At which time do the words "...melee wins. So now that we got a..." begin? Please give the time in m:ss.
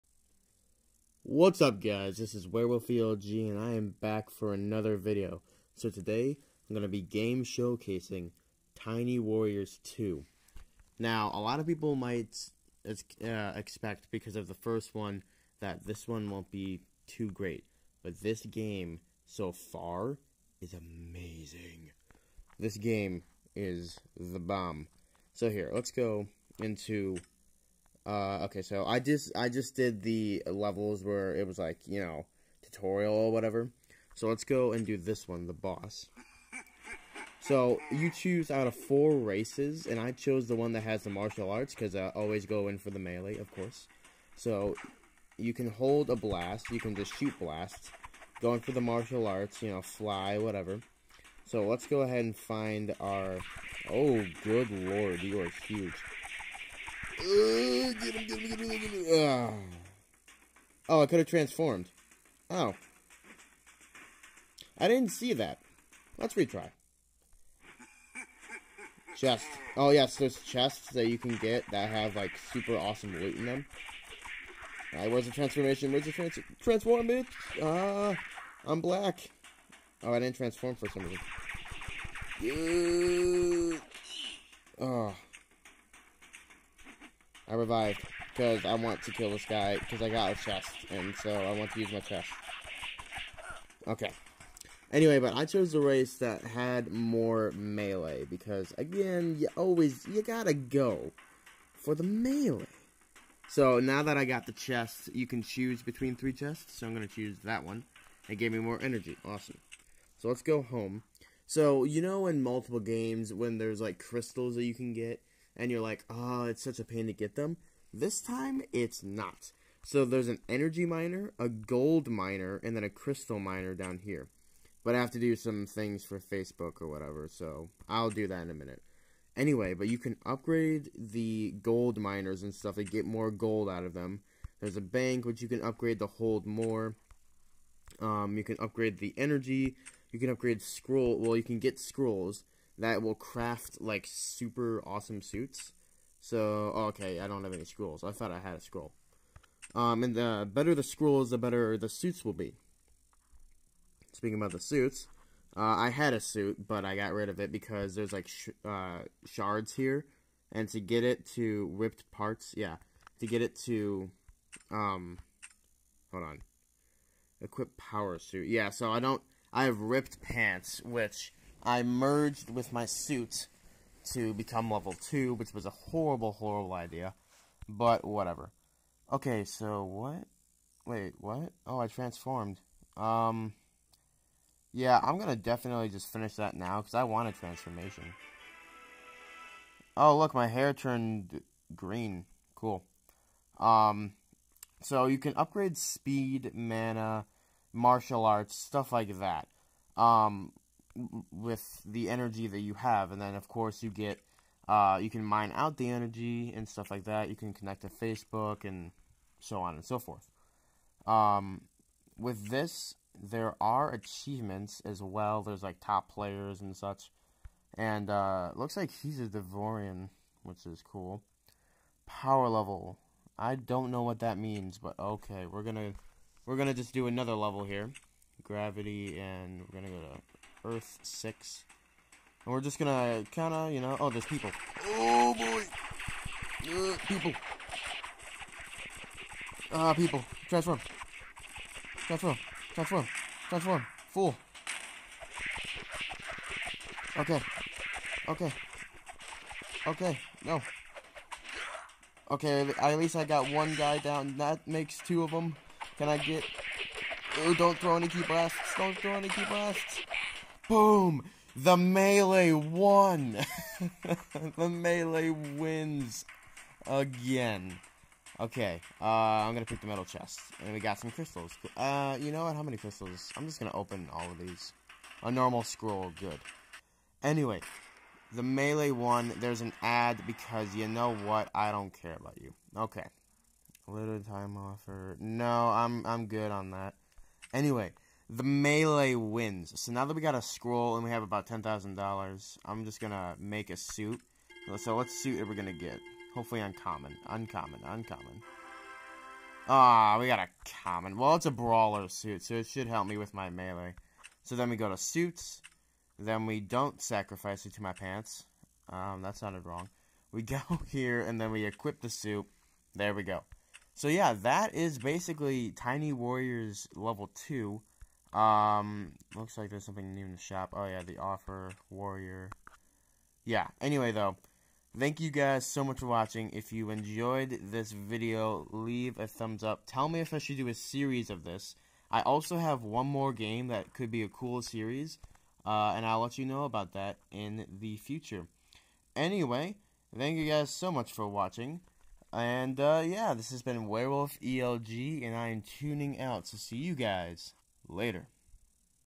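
4:48.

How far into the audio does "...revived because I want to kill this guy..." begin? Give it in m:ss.
1:27.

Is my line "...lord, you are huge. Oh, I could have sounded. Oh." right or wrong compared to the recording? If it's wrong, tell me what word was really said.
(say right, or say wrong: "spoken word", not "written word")
wrong: "transformed", not "sounded".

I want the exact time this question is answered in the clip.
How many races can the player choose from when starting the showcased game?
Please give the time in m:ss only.
0:38.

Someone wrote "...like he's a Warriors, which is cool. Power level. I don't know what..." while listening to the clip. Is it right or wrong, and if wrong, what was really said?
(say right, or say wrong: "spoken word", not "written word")
wrong: "Devorian", not "Warriors".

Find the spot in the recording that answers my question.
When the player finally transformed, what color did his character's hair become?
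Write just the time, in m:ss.
3:11.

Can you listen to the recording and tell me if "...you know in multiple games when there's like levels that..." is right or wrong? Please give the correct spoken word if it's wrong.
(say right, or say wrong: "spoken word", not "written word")
wrong: "crystals", not "levels".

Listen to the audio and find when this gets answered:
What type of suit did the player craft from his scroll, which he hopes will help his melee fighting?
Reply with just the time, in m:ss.
5:01.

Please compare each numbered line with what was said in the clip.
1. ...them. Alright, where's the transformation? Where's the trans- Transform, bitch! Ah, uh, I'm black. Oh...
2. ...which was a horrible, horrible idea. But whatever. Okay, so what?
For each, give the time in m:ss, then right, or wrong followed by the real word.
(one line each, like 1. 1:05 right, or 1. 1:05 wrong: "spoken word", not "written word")
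1. 1:13 right
2. 2:55 right.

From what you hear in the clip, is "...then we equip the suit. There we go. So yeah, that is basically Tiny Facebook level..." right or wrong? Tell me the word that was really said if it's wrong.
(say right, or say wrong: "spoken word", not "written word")
wrong: "Warriors", not "Facebook".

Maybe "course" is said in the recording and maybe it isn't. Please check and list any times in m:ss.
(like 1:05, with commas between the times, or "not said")
0:43, 3:23.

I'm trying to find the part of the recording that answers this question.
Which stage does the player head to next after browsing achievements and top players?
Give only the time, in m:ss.
3:50.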